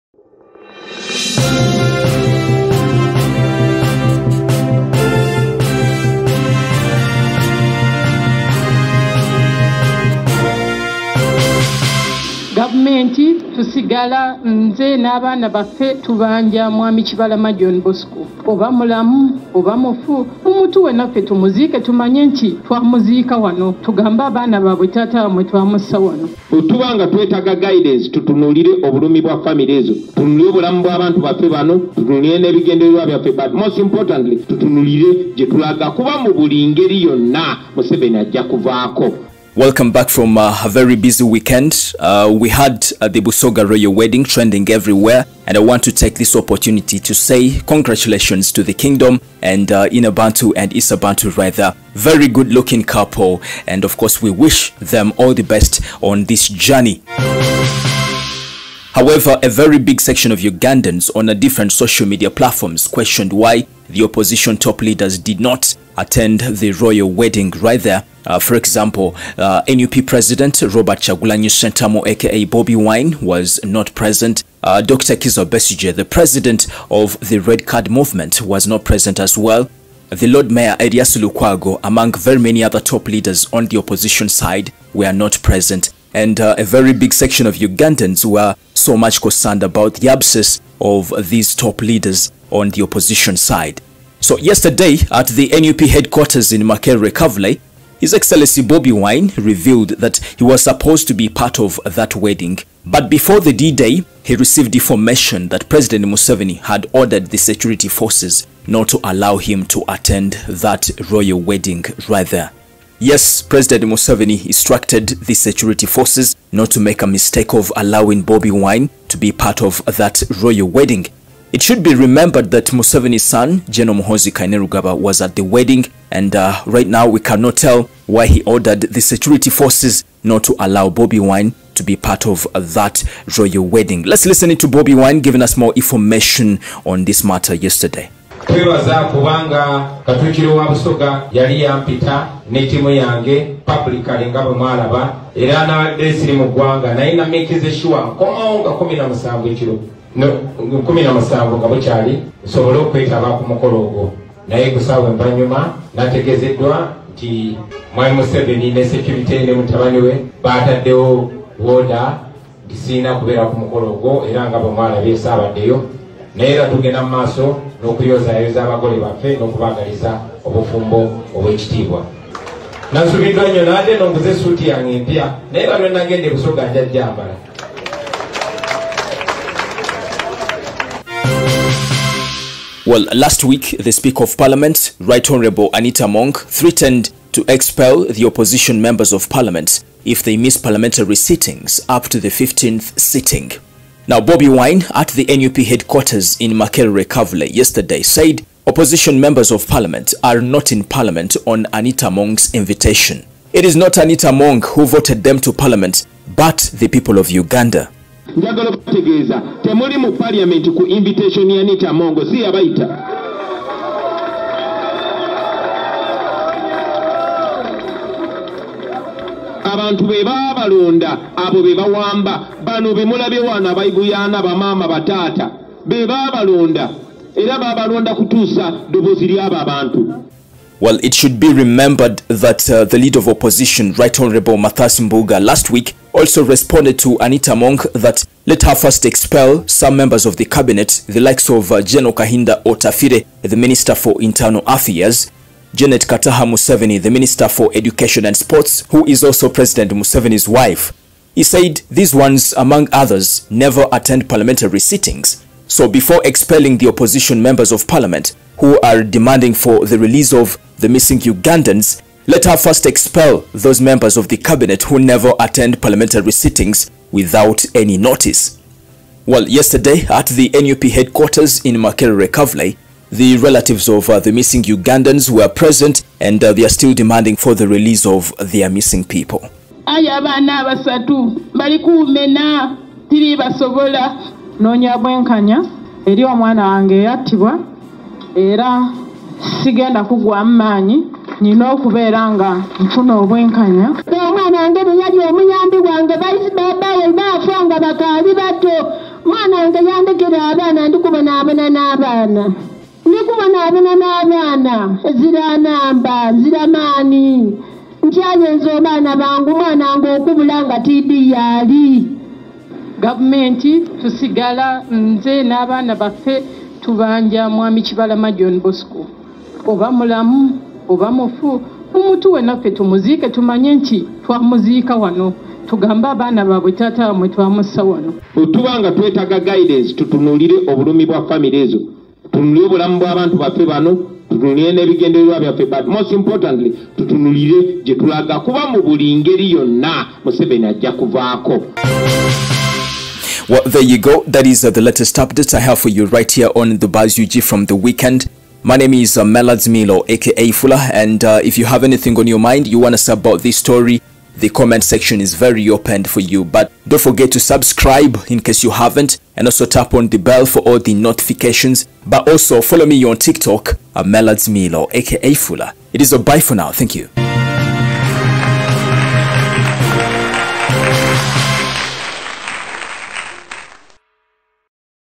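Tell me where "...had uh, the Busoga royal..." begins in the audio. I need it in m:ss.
0:42.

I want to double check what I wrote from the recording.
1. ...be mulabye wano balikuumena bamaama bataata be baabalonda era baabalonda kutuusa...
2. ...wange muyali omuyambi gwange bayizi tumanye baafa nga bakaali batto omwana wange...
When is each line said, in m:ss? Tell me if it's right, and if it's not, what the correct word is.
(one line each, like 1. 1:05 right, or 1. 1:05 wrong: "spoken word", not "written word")
1. 3:42 wrong: "abayiguyana", not "balikuumena"
2. 4:54 wrong: "babaye", not "tumanye".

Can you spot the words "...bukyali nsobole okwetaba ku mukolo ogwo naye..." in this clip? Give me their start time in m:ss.
2:31.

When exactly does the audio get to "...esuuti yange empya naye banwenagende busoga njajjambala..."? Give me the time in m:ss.
2:54.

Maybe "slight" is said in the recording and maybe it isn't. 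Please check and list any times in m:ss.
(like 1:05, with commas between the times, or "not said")
not said.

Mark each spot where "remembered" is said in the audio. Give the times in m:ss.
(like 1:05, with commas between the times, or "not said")
2:01, 3:51.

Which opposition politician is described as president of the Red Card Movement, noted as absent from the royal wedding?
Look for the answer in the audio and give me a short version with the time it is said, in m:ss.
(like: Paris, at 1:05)
Dr. Kizza Besigye, at 1:14.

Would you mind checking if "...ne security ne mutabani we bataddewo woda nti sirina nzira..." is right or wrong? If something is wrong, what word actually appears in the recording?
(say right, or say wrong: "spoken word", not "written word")
wrong: "kubeera", not "nzira".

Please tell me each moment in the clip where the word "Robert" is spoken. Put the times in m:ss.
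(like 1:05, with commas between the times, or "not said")
1:10.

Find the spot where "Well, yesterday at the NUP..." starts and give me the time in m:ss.
4:29.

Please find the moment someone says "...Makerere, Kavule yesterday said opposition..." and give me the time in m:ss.
3:16.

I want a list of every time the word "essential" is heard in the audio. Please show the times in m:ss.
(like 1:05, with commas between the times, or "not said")
not said.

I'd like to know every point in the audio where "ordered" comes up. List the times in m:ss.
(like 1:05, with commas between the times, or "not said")
1:46, 2:08.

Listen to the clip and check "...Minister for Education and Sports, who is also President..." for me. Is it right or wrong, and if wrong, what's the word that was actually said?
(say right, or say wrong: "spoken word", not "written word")
right.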